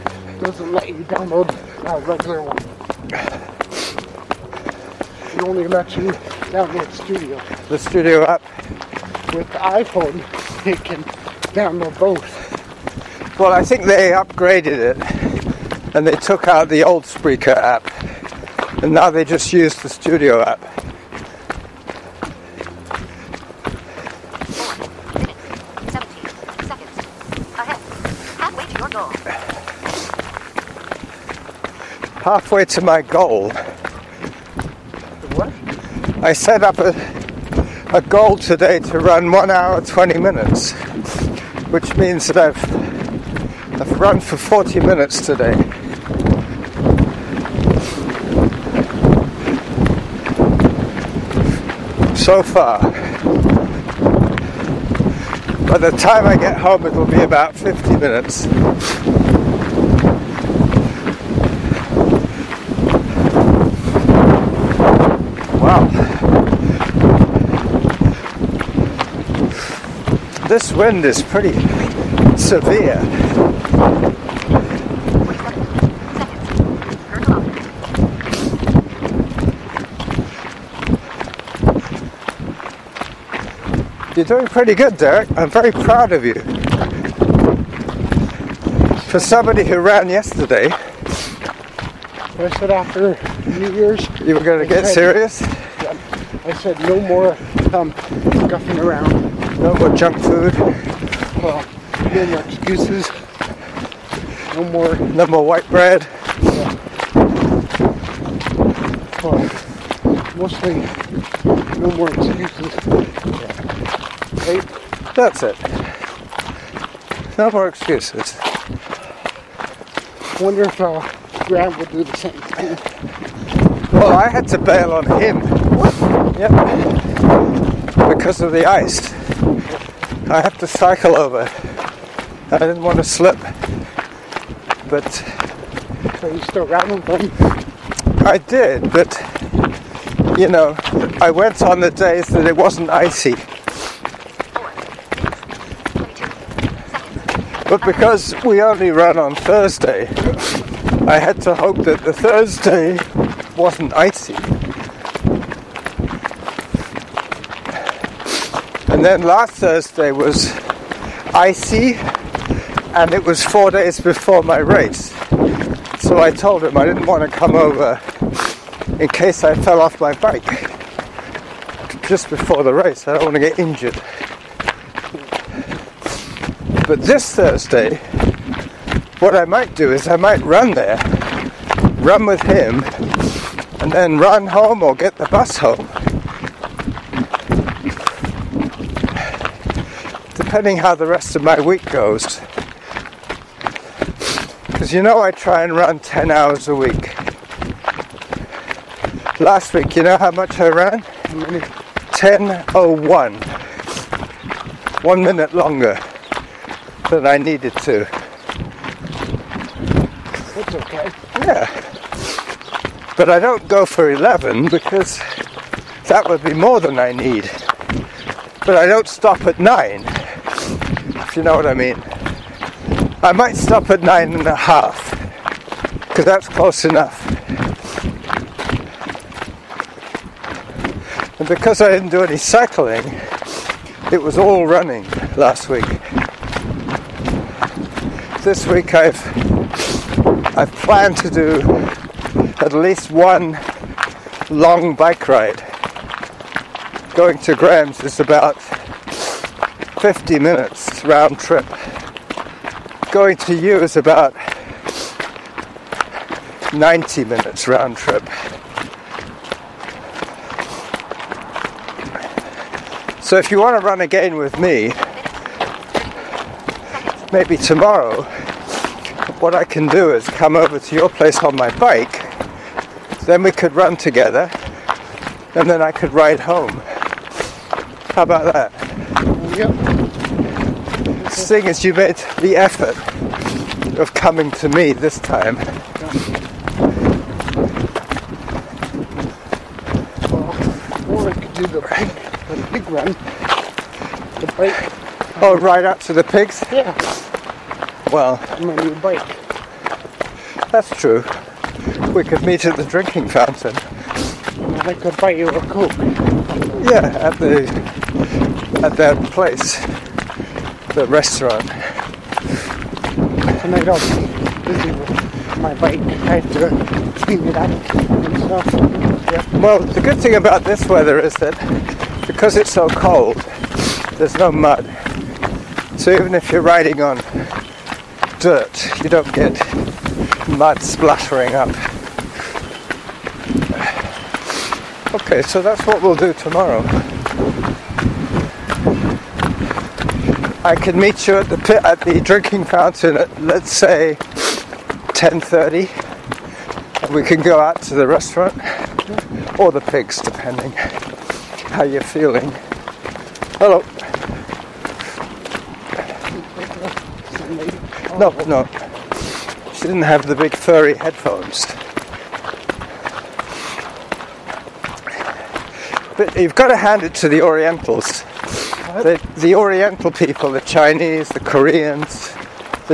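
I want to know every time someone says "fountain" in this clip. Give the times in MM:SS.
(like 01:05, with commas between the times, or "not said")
05:03, 05:42.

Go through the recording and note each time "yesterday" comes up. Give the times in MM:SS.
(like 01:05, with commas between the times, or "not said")
01:30.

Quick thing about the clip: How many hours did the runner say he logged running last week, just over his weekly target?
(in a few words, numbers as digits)
10.01.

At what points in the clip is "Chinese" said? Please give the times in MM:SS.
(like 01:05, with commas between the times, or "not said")
06:10.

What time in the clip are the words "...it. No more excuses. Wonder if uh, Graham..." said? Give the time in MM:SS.
01:55.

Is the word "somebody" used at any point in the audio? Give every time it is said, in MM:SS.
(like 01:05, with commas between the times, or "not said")
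01:29.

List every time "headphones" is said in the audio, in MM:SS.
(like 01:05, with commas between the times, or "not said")
06:00.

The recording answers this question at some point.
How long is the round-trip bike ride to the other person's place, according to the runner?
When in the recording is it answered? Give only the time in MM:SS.
04:16.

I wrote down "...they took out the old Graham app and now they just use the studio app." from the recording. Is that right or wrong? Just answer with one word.
wrong.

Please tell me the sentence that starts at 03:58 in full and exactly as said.
This week I've I've planned to do at least one long bike ride.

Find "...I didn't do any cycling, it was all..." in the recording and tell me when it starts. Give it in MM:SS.
03:51.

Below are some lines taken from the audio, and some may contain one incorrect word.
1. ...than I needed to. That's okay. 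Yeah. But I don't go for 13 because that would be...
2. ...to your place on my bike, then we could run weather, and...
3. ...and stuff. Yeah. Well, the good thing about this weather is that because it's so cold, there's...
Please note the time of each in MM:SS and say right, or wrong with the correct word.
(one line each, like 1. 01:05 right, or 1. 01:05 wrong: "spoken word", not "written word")
1. 03:27 wrong: "11", not "13"
2. 04:30 wrong: "together", not "weather"
3. 05:17 right.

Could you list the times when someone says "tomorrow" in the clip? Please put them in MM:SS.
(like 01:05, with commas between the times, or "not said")
04:27, 05:36.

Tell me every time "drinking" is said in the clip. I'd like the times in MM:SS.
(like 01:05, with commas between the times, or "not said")
05:02, 05:42.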